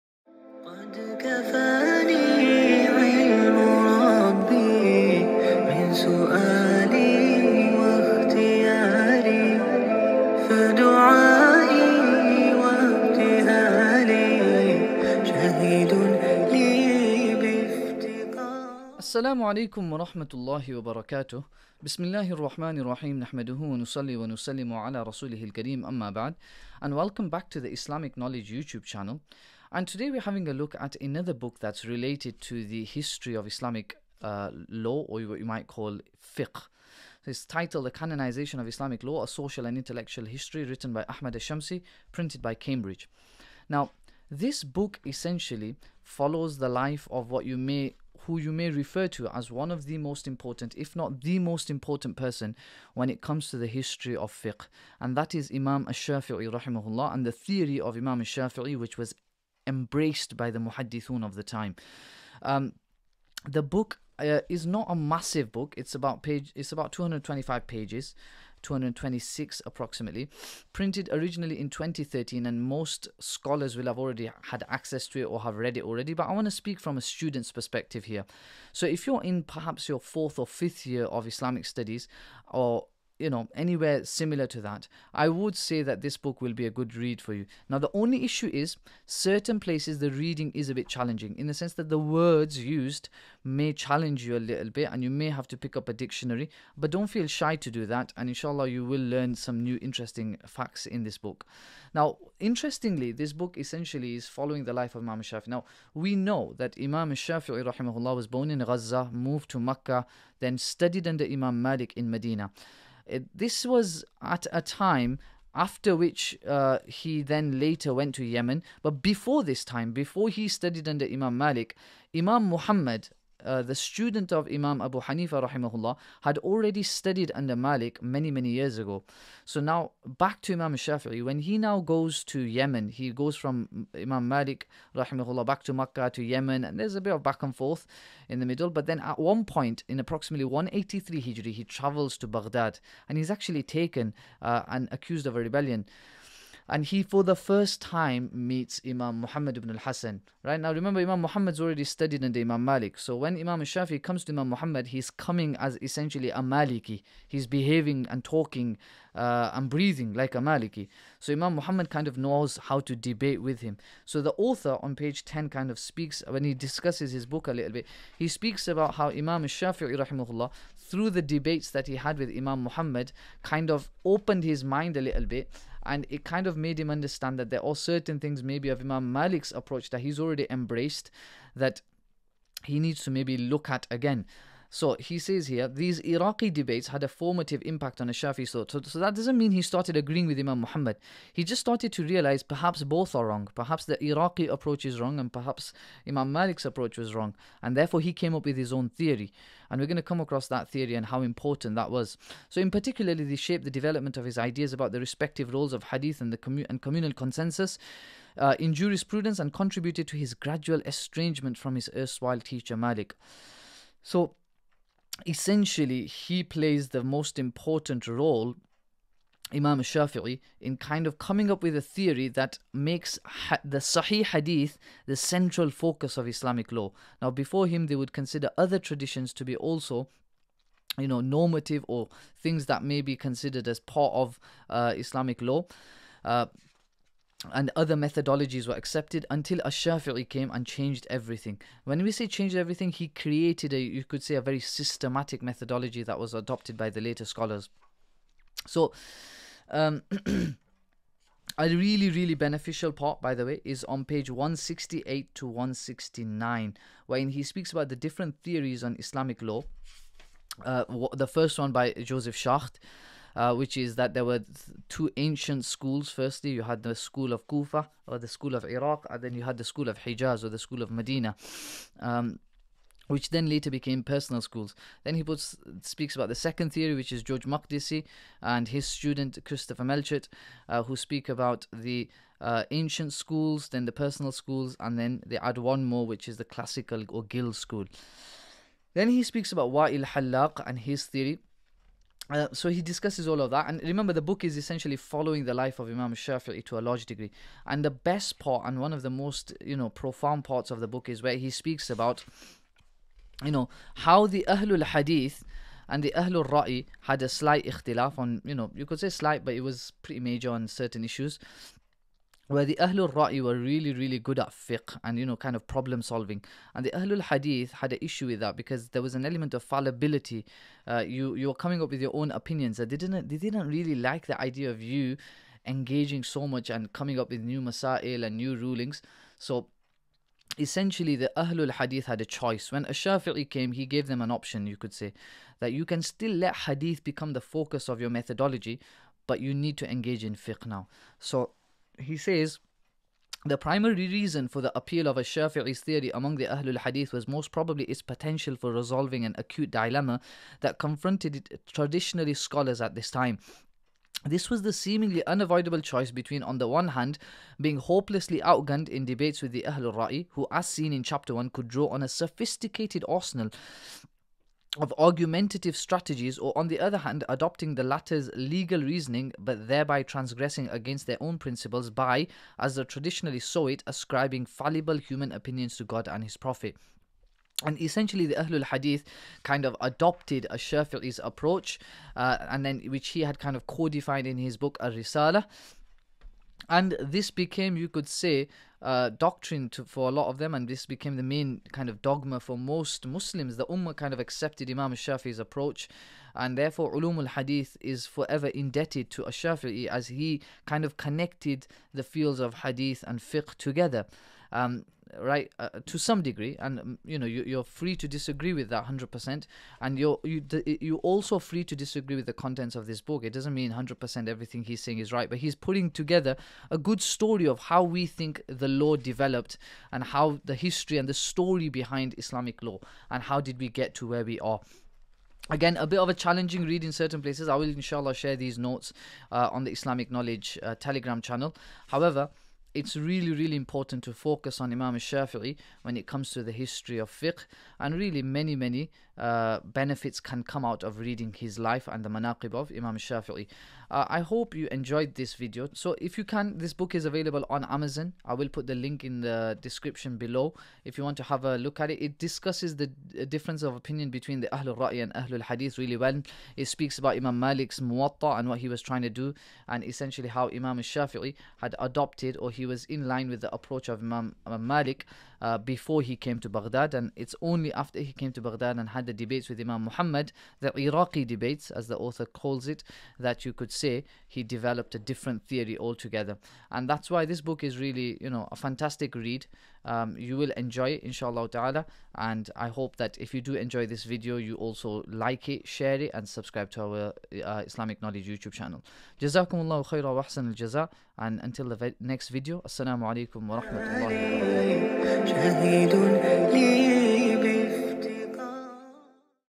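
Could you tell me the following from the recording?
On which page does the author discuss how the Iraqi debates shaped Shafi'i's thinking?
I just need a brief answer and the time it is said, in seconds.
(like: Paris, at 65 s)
10, at 164 s.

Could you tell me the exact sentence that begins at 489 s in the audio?
Jazakumullahu khairan wa ahsan al jaza.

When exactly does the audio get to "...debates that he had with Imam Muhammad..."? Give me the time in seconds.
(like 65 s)
171 s.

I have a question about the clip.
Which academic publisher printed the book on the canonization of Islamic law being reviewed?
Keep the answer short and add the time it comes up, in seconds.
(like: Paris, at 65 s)
Cambridge, at 42 s.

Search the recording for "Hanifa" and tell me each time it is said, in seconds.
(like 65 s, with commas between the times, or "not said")
125 s.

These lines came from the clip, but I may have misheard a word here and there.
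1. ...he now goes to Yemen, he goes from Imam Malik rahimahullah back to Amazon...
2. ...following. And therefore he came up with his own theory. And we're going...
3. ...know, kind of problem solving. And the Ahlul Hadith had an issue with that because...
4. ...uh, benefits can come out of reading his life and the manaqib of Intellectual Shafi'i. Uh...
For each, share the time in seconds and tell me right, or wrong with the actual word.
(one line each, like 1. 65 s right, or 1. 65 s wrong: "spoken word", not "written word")
1. 131 s wrong: "Makkah", not "Amazon"
2. 197 s wrong: "wrong", not "following"
3. 315 s right
4. 439 s wrong: "Imam", not "Intellectual".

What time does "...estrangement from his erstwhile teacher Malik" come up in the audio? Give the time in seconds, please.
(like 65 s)
210 s.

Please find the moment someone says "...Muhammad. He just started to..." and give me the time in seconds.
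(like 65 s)
190 s.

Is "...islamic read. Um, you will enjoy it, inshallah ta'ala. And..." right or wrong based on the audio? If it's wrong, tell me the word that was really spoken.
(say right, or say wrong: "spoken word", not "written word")
wrong: "fantastic", not "islamic".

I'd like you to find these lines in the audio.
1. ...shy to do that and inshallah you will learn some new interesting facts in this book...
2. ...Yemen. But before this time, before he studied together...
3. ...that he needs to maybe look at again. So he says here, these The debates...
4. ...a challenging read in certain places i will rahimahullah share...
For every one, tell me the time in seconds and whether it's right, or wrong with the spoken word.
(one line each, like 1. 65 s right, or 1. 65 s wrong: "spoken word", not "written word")
1. 97 s right
2. 118 s wrong: "under", not "together"
3. 181 s wrong: "Iraqi", not "The"
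4. 426 s wrong: "inshallah", not "rahimahullah".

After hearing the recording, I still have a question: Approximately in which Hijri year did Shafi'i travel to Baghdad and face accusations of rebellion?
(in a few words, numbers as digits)
183 Hijri.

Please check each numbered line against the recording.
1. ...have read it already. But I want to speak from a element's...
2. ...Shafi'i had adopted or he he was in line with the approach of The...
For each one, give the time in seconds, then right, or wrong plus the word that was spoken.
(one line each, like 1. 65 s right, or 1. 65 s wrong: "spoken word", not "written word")
1. 75 s wrong: "student", not "element"
2. 460 s wrong: "Imam", not "The".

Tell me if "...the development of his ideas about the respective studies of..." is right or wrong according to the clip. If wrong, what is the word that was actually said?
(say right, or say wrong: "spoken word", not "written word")
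wrong: "roles", not "studies".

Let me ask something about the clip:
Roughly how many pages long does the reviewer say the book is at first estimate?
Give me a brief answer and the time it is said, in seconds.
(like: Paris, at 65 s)
225, at 66 s.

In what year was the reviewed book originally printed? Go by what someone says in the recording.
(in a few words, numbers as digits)
2013.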